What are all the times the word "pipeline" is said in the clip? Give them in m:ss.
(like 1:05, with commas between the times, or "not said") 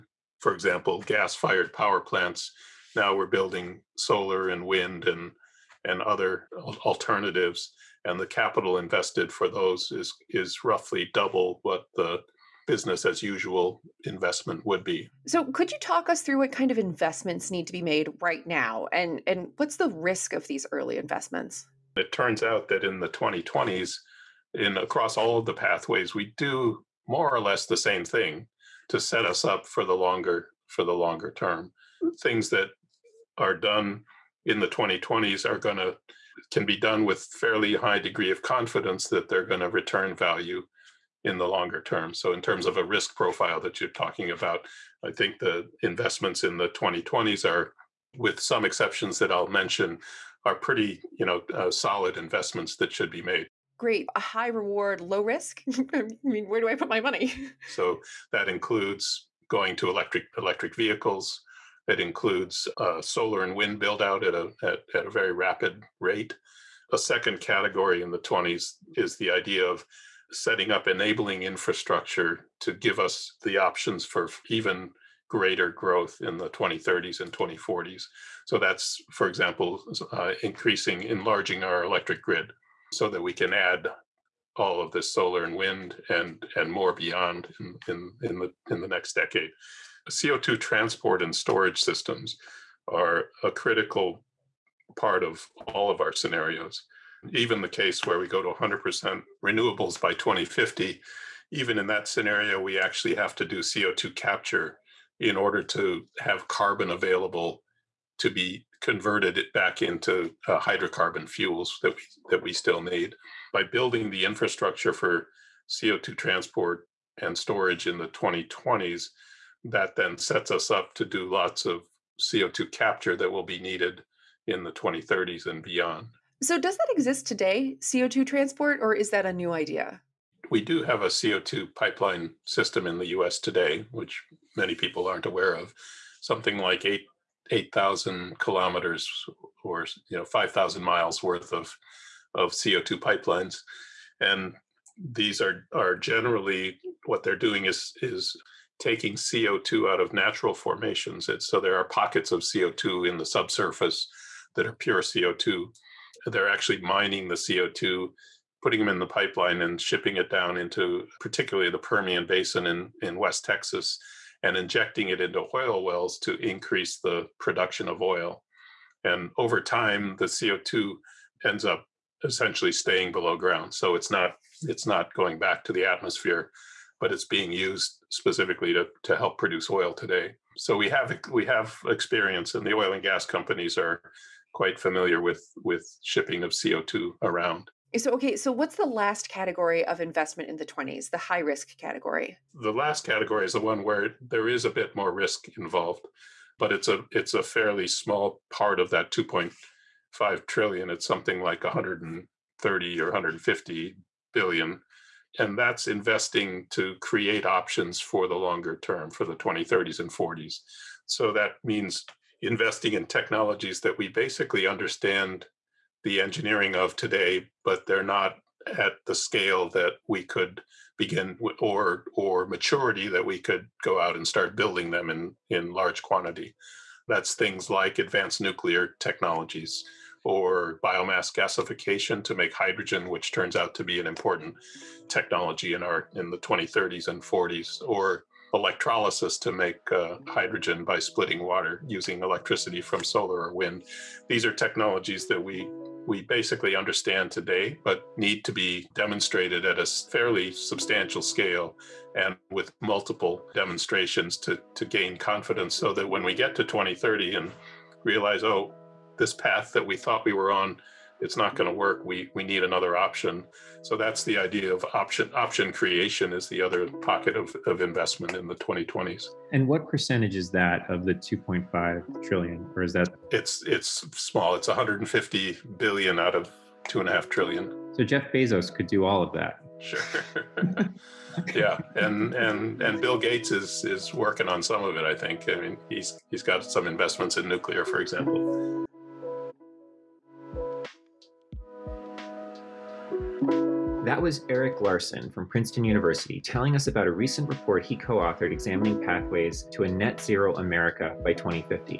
2:11, 2:22, 2:39.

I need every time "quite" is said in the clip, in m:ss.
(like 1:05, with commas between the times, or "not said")
3:04.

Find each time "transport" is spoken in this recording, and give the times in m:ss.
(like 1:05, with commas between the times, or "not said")
1:30, 1:56, 2:08.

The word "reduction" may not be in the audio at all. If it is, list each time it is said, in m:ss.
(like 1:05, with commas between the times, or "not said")
not said.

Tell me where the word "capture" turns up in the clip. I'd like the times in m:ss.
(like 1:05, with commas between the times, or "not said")
1:44, 2:02.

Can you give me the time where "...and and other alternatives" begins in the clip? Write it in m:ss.
0:05.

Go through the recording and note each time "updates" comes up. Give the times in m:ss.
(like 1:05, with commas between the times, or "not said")
not said.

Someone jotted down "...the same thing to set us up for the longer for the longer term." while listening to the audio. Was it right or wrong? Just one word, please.
right.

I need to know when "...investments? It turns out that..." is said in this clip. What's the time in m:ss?
0:20.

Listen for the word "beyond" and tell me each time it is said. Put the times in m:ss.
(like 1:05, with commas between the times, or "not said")
1:26, 2:05.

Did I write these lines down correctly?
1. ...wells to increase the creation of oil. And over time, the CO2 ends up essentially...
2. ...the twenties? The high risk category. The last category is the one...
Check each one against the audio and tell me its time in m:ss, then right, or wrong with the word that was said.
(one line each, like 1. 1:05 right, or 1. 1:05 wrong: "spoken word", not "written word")
1. 2:45 wrong: "production", not "creation"
2. 3:10 right.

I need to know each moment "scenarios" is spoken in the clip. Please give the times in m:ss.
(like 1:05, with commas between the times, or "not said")
1:36, 1:42.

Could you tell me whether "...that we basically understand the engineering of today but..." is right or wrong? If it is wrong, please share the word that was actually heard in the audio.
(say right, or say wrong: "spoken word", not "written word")
right.